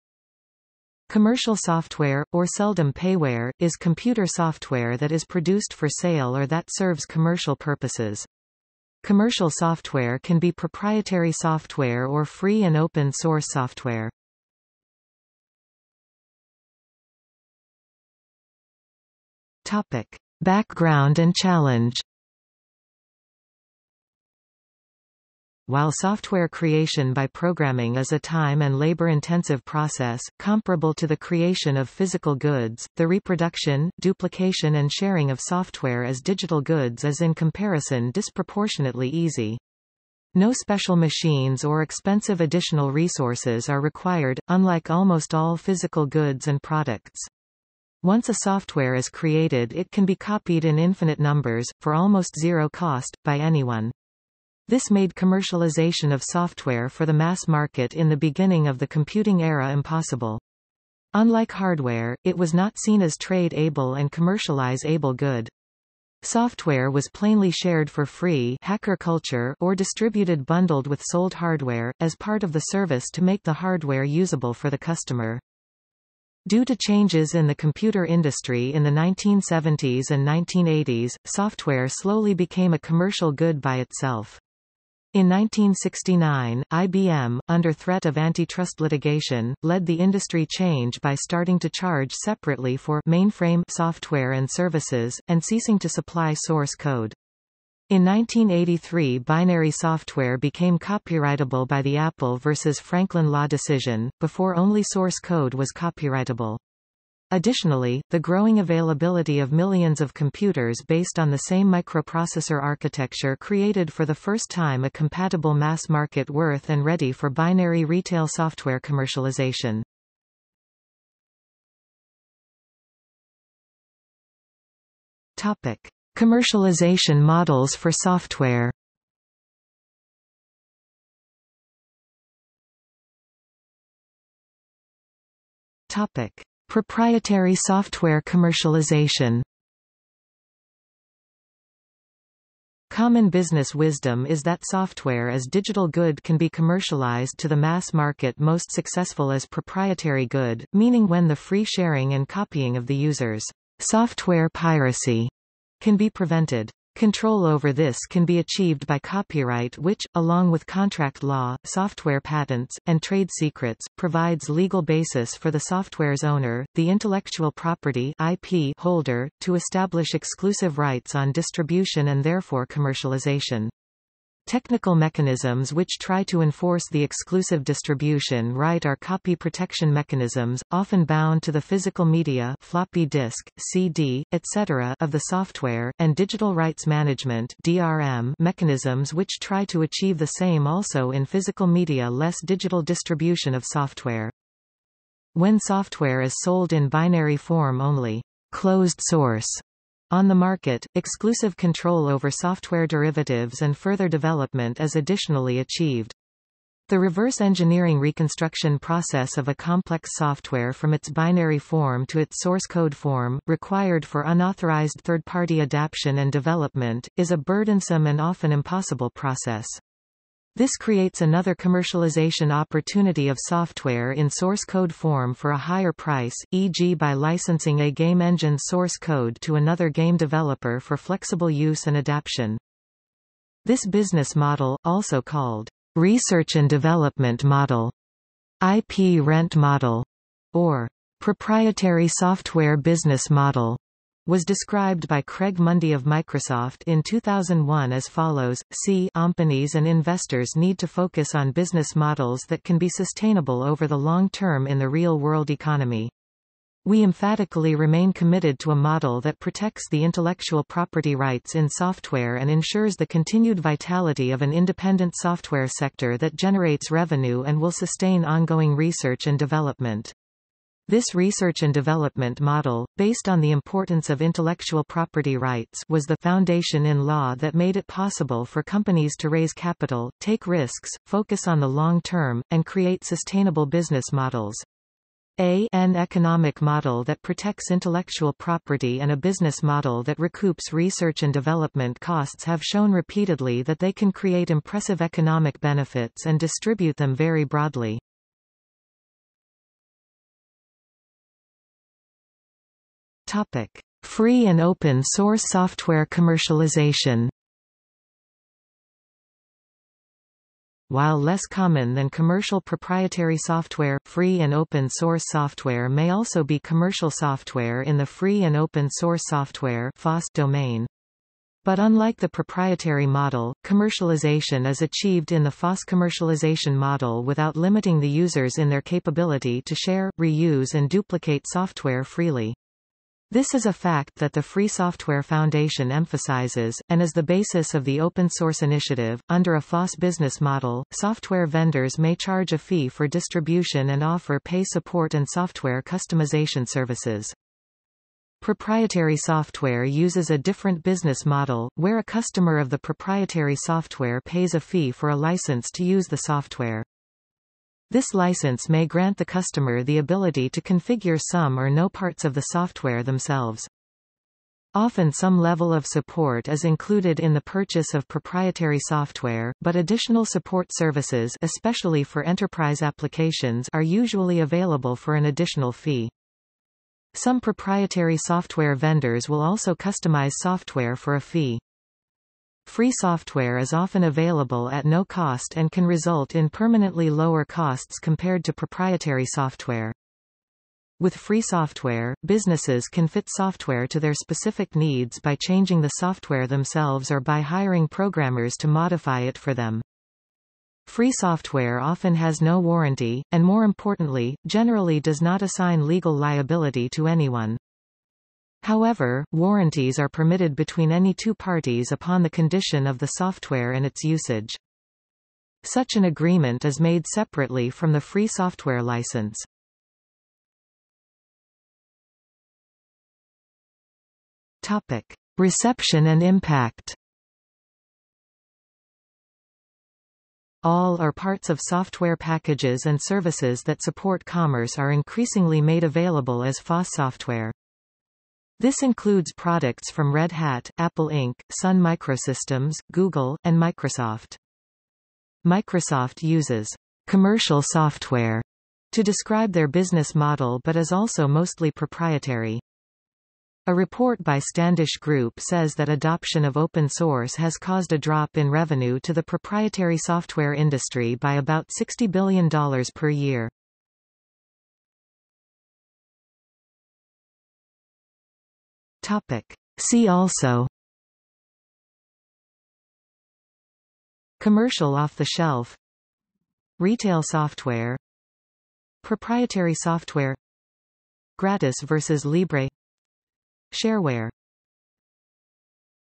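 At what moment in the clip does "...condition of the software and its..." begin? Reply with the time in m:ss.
6:52.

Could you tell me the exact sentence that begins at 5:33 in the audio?
This is a fact that the Free Software Foundation emphasizes, and is the basis of the open source initiative.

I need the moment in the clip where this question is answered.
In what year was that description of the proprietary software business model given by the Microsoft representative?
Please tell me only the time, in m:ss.
4:07.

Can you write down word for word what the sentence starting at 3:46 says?
by licensing a game engine source code to another game developer for flexible use and adaptation.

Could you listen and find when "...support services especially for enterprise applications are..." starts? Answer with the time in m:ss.
6:10.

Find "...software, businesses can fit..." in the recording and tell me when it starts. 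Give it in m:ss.
6:31.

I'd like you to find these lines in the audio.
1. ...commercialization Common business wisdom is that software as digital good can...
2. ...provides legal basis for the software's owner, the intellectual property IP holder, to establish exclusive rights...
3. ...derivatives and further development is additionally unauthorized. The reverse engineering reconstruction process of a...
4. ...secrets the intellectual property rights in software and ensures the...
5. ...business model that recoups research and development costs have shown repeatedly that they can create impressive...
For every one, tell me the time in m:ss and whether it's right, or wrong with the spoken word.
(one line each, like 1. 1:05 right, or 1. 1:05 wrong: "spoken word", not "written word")
1. 2:18 right
2. 2:43 right
3. 3:22 wrong: "achieved", not "unauthorized"
4. 4:19 wrong: "protects", not "secrets"
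5. 4:49 right.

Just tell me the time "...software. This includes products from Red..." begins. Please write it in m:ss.
7:16.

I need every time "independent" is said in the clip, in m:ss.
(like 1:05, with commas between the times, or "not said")
4:24.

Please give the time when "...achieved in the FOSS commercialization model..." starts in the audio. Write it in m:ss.
5:24.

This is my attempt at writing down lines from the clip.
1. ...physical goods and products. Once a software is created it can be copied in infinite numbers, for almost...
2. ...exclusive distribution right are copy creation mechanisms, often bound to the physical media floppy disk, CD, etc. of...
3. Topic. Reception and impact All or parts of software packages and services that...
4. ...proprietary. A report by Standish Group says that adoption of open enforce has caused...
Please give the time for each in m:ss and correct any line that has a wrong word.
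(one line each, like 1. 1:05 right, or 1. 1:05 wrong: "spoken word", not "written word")
1. 0:45 right
2. 2:57 wrong: "protection", not "creation"
3. 7:04 right
4. 7:31 wrong: "source", not "enforce".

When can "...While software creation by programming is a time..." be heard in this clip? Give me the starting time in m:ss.
0:25.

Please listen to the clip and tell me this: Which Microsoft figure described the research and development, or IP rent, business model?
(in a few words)
Craig Mundie.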